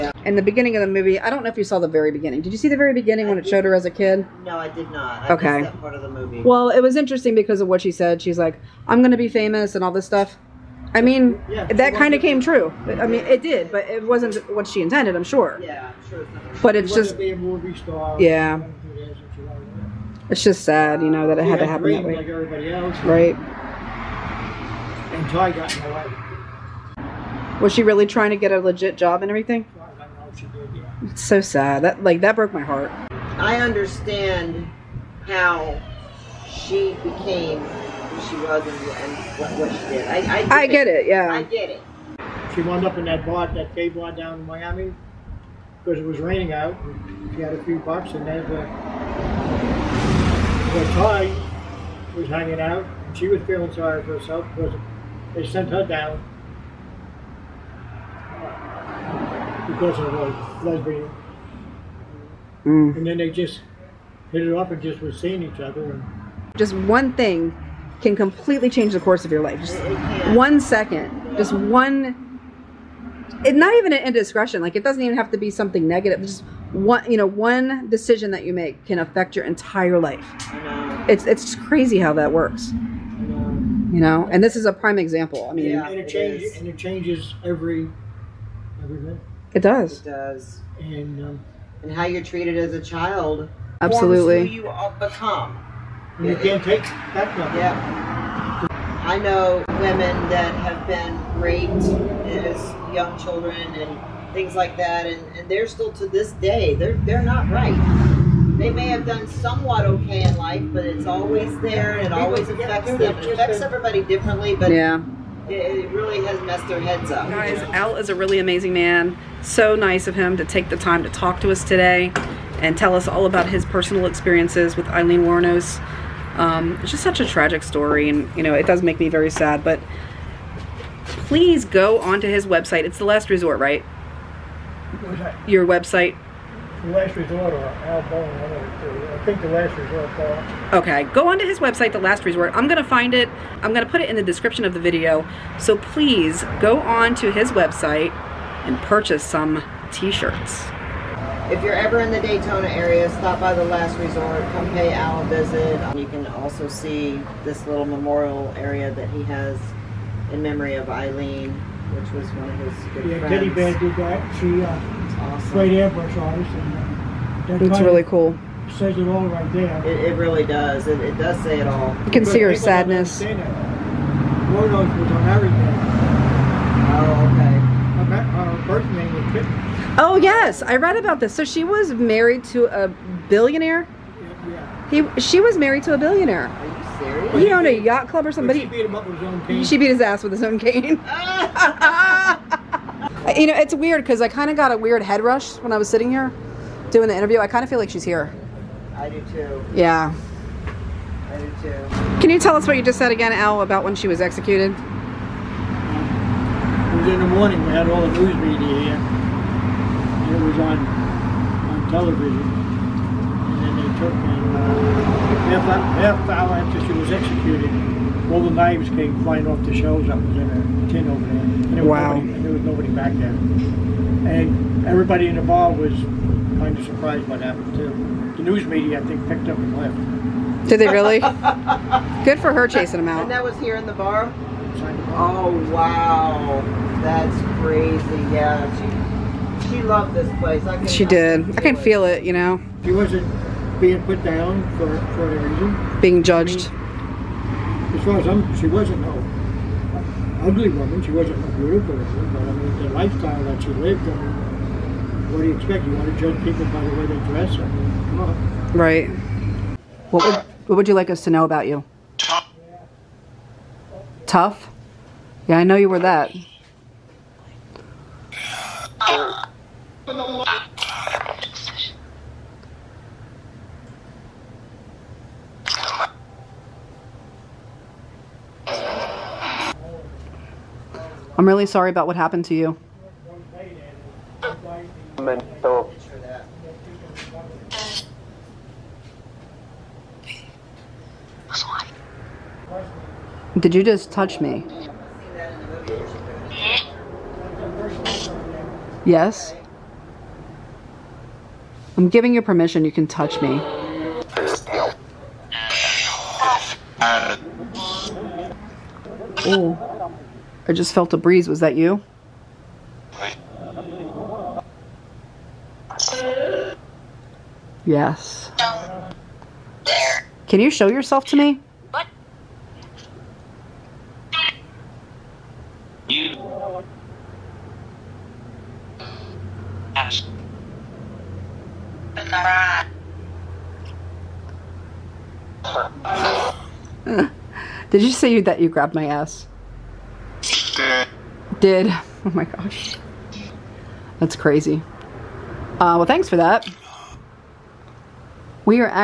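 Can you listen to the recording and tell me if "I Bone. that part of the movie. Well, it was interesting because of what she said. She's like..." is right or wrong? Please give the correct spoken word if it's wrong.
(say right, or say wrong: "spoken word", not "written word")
wrong: "Okay", not "Bone".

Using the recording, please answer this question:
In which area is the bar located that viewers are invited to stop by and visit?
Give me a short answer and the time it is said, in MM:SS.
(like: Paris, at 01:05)
Daytona, at 02:32.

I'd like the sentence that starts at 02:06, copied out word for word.
Um, it's just such a tragic story, and you know it does make me very sad.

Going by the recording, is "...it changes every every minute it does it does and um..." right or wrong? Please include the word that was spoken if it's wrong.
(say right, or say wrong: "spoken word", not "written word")
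right.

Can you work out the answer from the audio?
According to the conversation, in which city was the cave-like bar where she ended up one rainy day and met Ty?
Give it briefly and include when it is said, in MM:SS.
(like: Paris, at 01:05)
Miami, at 00:44.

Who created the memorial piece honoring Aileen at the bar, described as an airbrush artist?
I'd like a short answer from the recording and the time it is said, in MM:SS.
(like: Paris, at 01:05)
Teddy Bear, at 02:43.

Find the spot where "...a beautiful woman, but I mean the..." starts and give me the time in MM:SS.
04:11.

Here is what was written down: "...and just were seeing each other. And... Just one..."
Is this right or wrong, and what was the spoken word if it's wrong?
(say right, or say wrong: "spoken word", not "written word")
right.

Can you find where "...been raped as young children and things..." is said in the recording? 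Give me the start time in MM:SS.
01:40.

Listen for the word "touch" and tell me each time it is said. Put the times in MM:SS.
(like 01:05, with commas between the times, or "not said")
04:54, 05:03.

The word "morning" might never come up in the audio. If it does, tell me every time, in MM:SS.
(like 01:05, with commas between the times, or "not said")
03:27.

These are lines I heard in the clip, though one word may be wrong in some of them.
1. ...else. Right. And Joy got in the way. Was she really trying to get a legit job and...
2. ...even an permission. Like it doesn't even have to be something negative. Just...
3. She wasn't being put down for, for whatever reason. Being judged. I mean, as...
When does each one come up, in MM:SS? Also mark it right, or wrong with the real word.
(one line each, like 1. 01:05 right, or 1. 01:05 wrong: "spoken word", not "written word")
1. 00:22 right
2. 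01:13 wrong: "indiscretion", not "permission"
3. 04:02 right.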